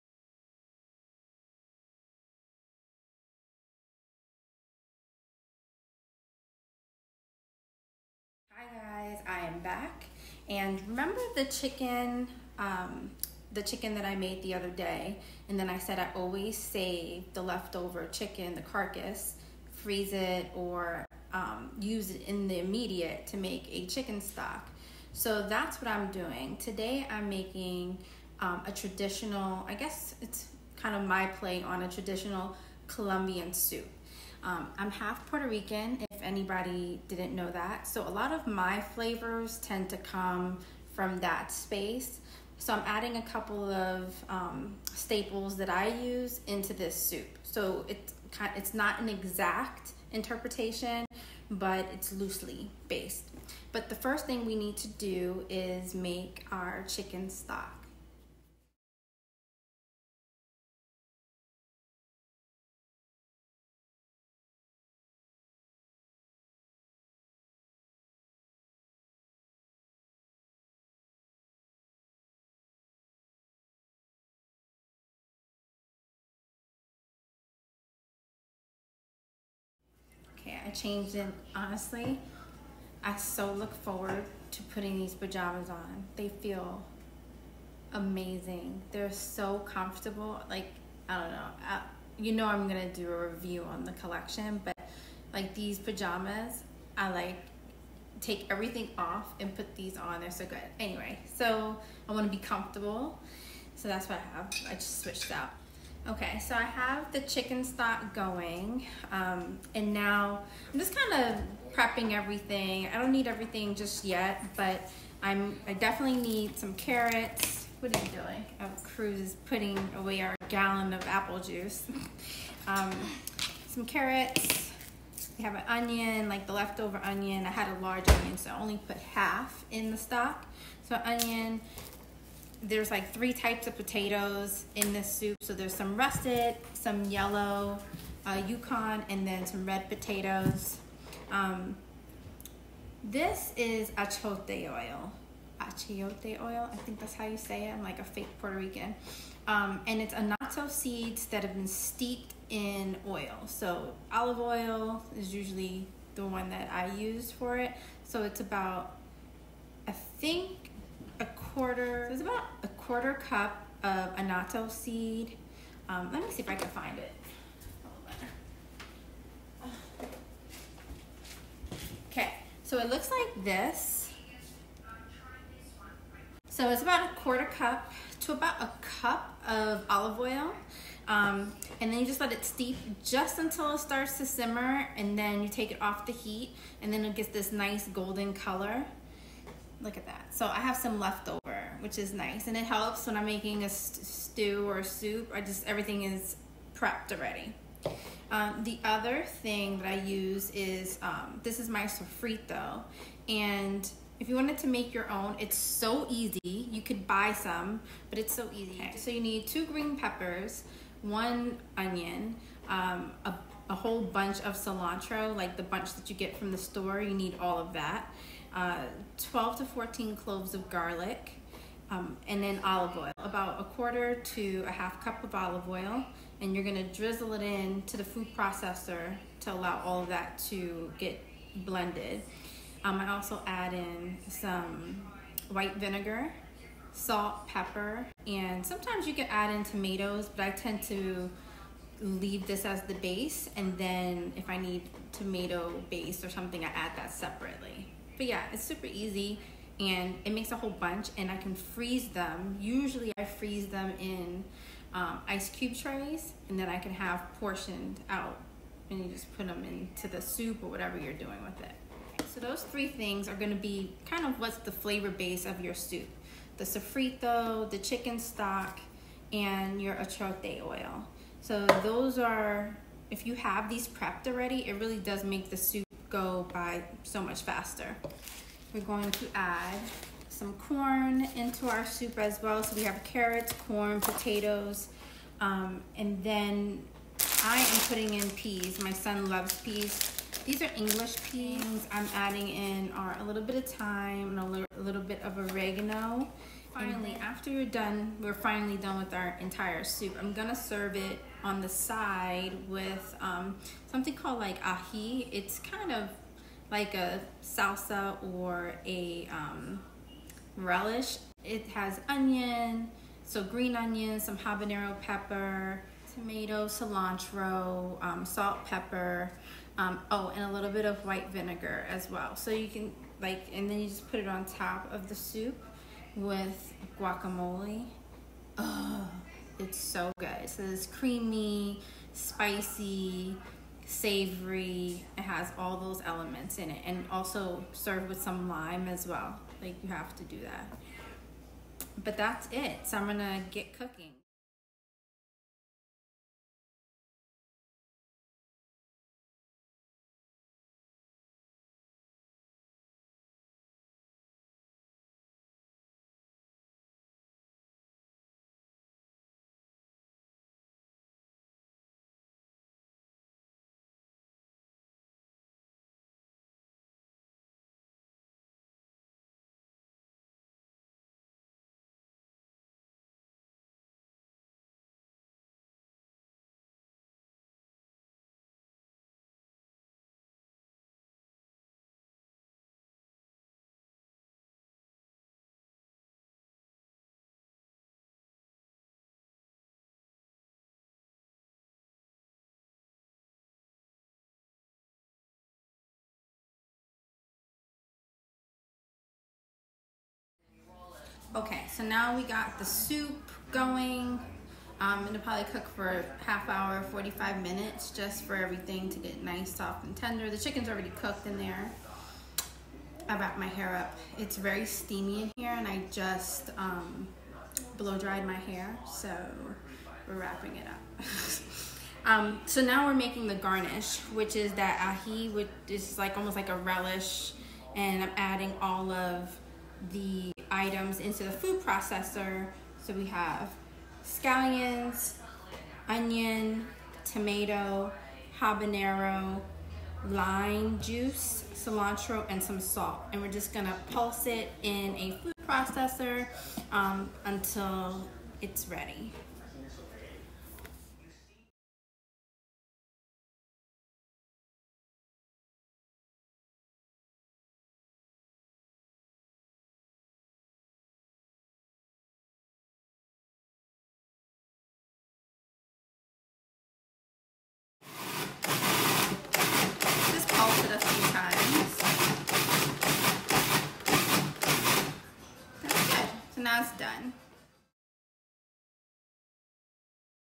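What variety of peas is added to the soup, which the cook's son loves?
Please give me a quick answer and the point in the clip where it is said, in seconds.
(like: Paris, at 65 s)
English peas, at 290 s.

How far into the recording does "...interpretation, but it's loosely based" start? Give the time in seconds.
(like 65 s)
50 s.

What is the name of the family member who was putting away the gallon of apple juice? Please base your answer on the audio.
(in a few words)
Cruz.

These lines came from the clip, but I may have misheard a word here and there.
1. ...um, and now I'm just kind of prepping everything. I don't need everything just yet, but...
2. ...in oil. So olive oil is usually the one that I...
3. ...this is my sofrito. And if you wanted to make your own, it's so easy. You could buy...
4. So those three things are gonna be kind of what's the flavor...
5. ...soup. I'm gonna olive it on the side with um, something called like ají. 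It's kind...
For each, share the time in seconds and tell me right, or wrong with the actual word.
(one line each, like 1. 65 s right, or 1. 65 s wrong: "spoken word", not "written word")
1. 109 s right
2. 152 s right
3. 201 s right
4. 262 s right
5. 299 s wrong: "serve", not "olive".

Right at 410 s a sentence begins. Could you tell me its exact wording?
The chicken's already cooked in there.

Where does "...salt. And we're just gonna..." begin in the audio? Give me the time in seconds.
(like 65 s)
442 s.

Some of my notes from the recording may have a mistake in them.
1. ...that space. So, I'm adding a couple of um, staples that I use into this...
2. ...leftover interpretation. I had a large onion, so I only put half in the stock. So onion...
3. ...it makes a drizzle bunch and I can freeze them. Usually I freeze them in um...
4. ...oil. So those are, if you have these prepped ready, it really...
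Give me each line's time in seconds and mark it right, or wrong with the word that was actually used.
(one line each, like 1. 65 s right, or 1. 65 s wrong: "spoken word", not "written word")
1. 41 s right
2. 126 s wrong: "onion", not "interpretation"
3. 250 s wrong: "whole", not "drizzle"
4. 270 s wrong: "already", not "ready".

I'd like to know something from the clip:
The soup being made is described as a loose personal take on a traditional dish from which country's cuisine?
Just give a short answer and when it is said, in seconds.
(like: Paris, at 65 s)
Colombian, at 32 s.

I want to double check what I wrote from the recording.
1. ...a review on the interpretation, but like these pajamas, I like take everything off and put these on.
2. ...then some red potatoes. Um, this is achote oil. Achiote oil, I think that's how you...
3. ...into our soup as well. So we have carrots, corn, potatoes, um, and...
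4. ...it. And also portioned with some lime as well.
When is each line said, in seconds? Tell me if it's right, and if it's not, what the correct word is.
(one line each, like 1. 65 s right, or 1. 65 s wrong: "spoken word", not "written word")
1. 93 s wrong: "collection", not "interpretation"
2. 139 s right
3. 281 s right
4. 336 s wrong: "served", not "portioned".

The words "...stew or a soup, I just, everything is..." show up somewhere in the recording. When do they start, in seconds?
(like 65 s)
194 s.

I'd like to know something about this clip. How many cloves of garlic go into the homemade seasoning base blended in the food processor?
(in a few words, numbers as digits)
12 to 14.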